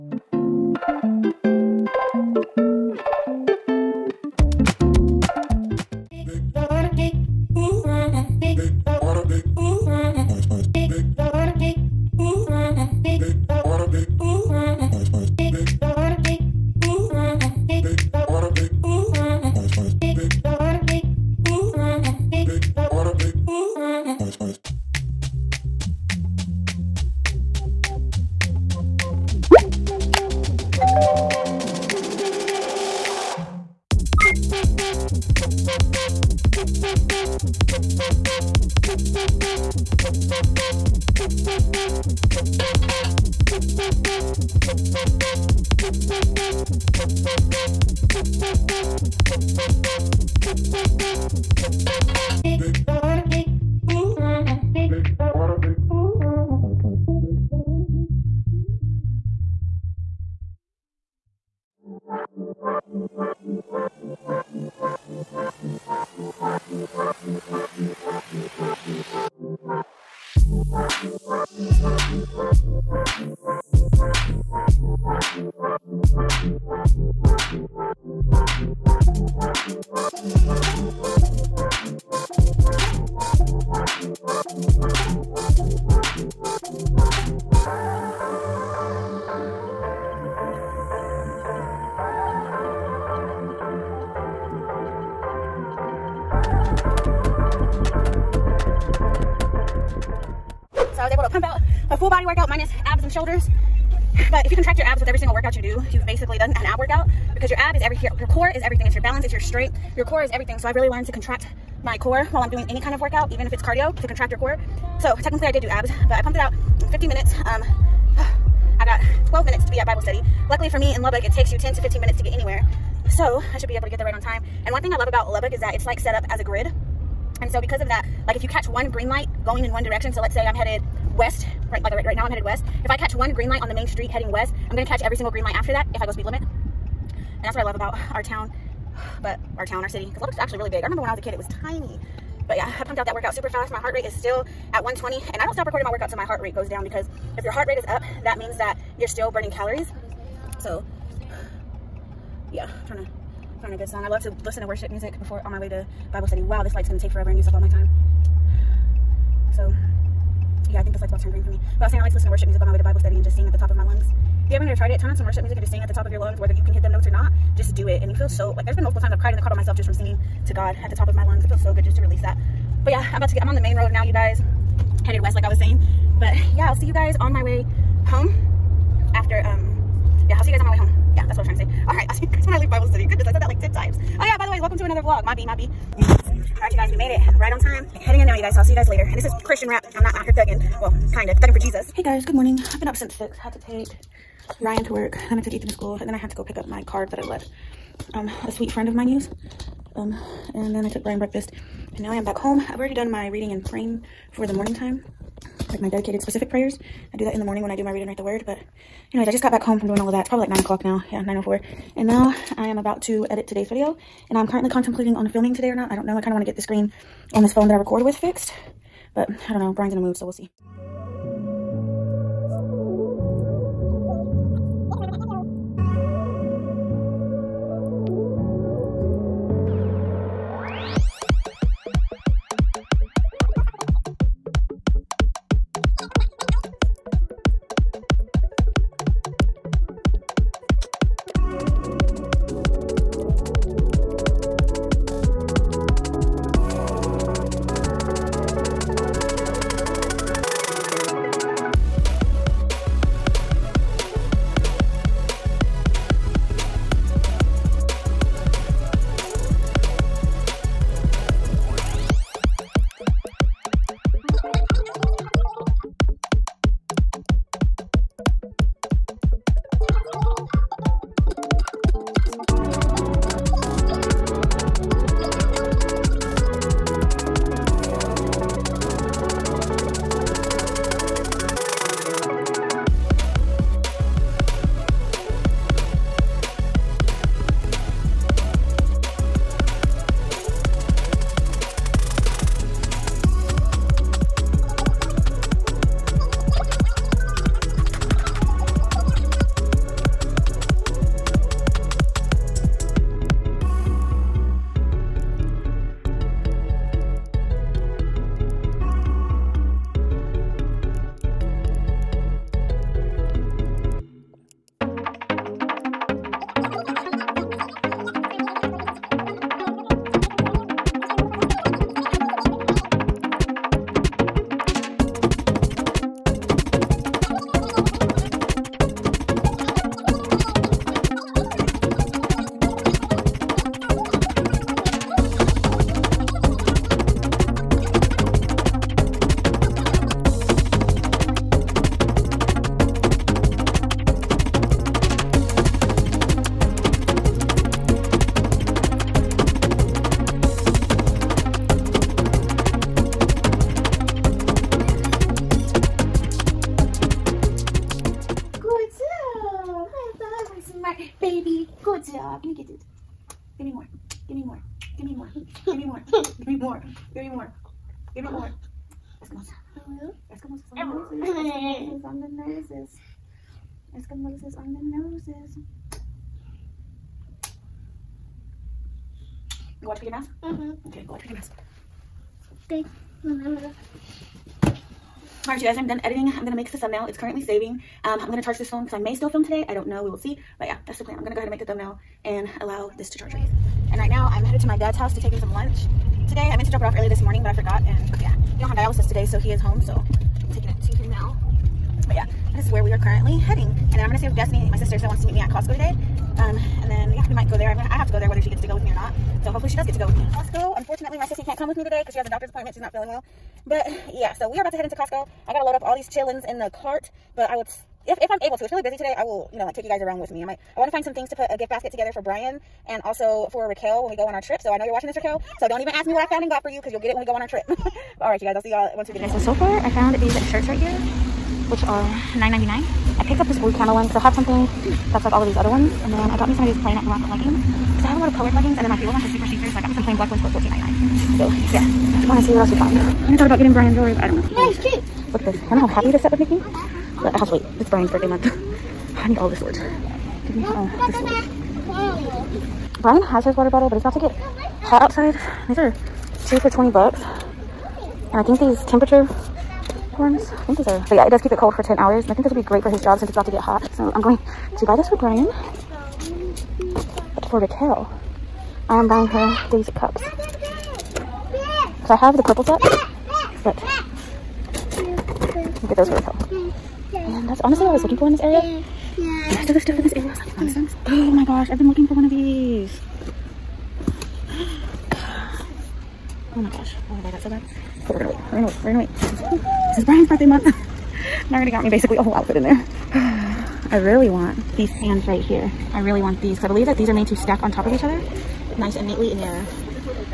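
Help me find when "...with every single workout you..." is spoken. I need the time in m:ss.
1:45.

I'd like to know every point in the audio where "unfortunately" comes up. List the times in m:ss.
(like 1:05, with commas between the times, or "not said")
6:50.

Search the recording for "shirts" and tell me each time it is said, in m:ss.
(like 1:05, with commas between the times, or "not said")
7:10.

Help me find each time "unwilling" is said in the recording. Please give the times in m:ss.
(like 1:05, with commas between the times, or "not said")
not said.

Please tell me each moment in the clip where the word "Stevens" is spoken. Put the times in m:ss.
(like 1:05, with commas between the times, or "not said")
not said.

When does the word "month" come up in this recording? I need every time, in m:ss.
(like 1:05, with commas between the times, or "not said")
7:28, 8:10.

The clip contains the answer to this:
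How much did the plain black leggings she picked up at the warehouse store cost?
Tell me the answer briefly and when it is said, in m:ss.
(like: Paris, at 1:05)
$14.99, at 7:20.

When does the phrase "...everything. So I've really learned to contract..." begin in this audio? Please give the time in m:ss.
1:50.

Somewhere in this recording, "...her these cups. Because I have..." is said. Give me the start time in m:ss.
7:49.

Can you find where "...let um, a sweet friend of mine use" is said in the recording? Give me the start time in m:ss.
3:17.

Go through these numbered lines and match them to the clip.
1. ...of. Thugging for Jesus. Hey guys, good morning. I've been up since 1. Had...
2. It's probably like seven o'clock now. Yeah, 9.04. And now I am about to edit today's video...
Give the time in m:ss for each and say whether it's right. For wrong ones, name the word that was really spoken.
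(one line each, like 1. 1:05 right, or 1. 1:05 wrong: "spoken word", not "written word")
1. 3:11 wrong: "6", not "1"
2. 3:30 wrong: "nine", not "seven".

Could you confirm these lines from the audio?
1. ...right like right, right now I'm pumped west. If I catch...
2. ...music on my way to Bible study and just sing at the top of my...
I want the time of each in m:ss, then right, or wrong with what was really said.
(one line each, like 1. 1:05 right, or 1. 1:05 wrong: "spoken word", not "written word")
1. 2:11 wrong: "headed", not "pumped"
2. 2:42 right.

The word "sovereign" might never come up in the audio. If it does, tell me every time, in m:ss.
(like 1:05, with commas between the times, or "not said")
not said.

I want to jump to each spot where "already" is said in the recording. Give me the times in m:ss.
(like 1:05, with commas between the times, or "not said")
3:22, 8:11.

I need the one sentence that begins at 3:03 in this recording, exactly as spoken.
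Goodness, I said that like 10 times.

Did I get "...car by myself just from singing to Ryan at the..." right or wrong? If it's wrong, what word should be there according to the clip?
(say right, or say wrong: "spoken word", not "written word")
wrong: "God", not "Ryan".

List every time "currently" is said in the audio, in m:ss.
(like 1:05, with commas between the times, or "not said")
3:34, 6:27, 6:42.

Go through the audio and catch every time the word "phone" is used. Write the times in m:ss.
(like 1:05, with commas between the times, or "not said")
3:37, 6:28.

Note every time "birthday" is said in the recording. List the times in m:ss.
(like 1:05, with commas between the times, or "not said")
7:28, 8:10.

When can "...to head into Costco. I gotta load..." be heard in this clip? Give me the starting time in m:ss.
6:54.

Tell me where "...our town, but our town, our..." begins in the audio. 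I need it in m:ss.
2:18.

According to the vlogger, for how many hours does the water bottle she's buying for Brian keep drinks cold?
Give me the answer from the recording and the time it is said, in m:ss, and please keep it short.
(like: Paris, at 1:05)
10 hours, at 7:41.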